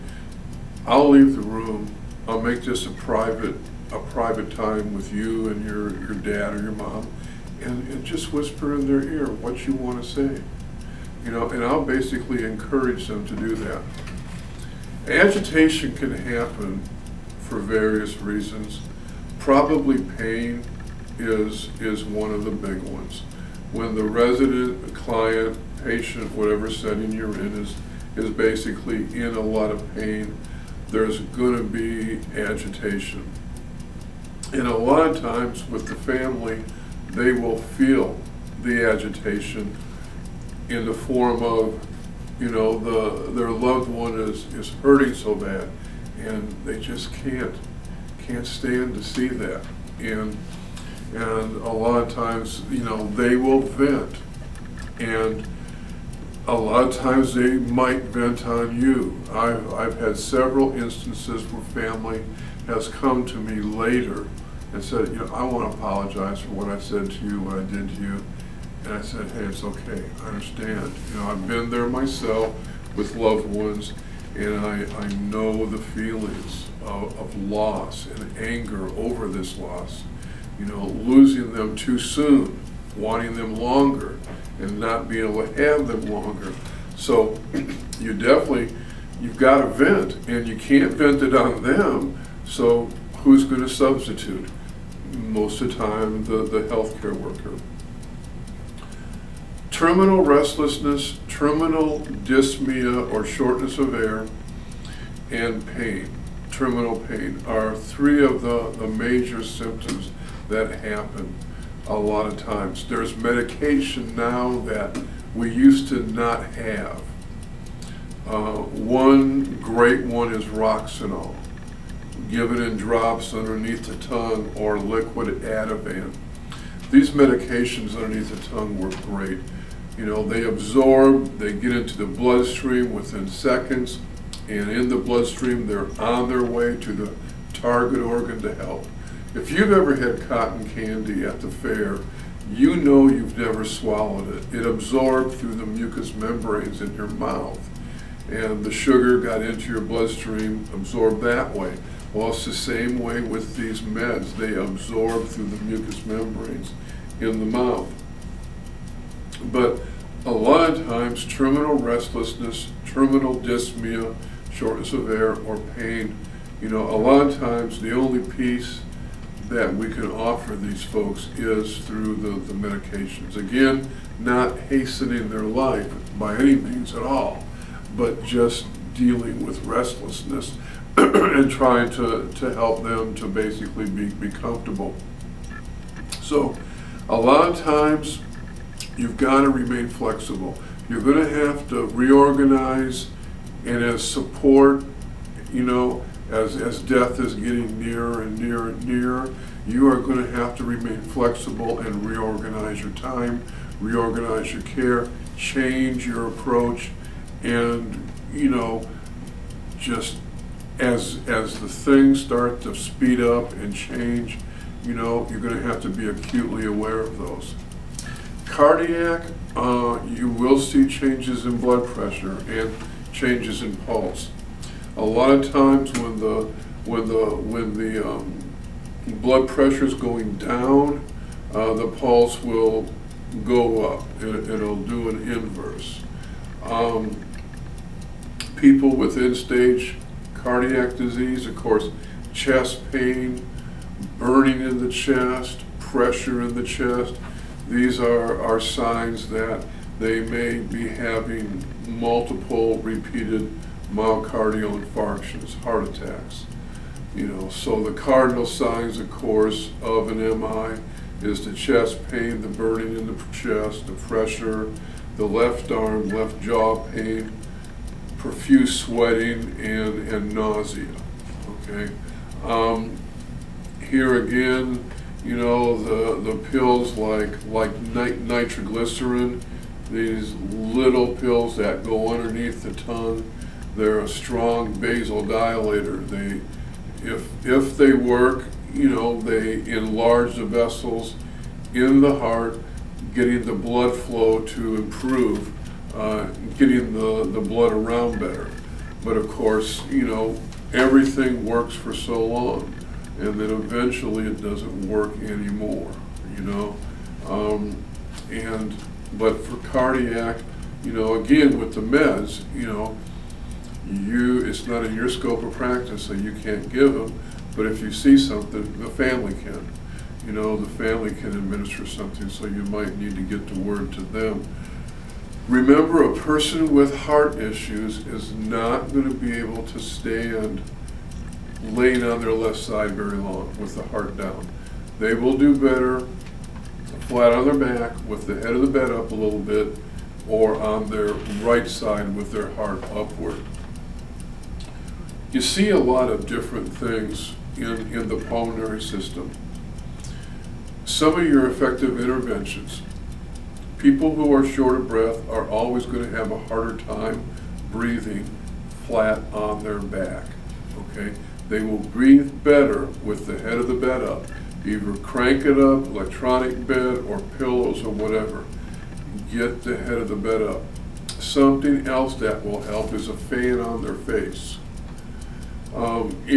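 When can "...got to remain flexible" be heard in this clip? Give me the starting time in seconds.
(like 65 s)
189 s.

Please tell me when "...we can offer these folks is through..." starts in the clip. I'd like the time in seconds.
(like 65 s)
169 s.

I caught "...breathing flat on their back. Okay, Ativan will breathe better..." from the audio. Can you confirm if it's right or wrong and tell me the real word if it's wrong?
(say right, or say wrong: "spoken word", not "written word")
wrong: "They", not "Ativan".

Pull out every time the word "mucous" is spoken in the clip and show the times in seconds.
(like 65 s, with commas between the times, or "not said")
145 s, 155 s.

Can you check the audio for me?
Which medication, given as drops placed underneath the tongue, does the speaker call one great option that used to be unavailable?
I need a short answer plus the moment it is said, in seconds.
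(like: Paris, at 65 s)
Roxanol, at 120 s.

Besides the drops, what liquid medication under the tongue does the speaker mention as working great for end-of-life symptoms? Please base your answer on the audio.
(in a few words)
Ativan.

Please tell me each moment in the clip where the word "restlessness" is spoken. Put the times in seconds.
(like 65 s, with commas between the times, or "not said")
100 s, 161 s, 179 s.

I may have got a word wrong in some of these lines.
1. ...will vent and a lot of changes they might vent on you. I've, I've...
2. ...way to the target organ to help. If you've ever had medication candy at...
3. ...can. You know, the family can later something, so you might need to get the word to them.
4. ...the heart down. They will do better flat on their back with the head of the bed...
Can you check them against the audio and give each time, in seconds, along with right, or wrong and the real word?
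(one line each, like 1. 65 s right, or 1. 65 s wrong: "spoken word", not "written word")
1. 53 s wrong: "times", not "changes"
2. 136 s wrong: "cotton", not "medication"
3. 319 s wrong: "administer", not "later"
4. 333 s right.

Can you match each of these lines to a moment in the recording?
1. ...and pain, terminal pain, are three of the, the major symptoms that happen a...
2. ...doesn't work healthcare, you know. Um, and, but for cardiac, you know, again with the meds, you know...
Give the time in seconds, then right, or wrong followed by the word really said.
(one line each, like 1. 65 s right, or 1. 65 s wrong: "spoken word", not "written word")
1. 105 s right
2. 304 s wrong: "anymore", not "healthcare".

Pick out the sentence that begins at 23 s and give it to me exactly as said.
When the resident, client, patient, whatever setting you're in is is basically in a lot of pain, there's going to be agitation.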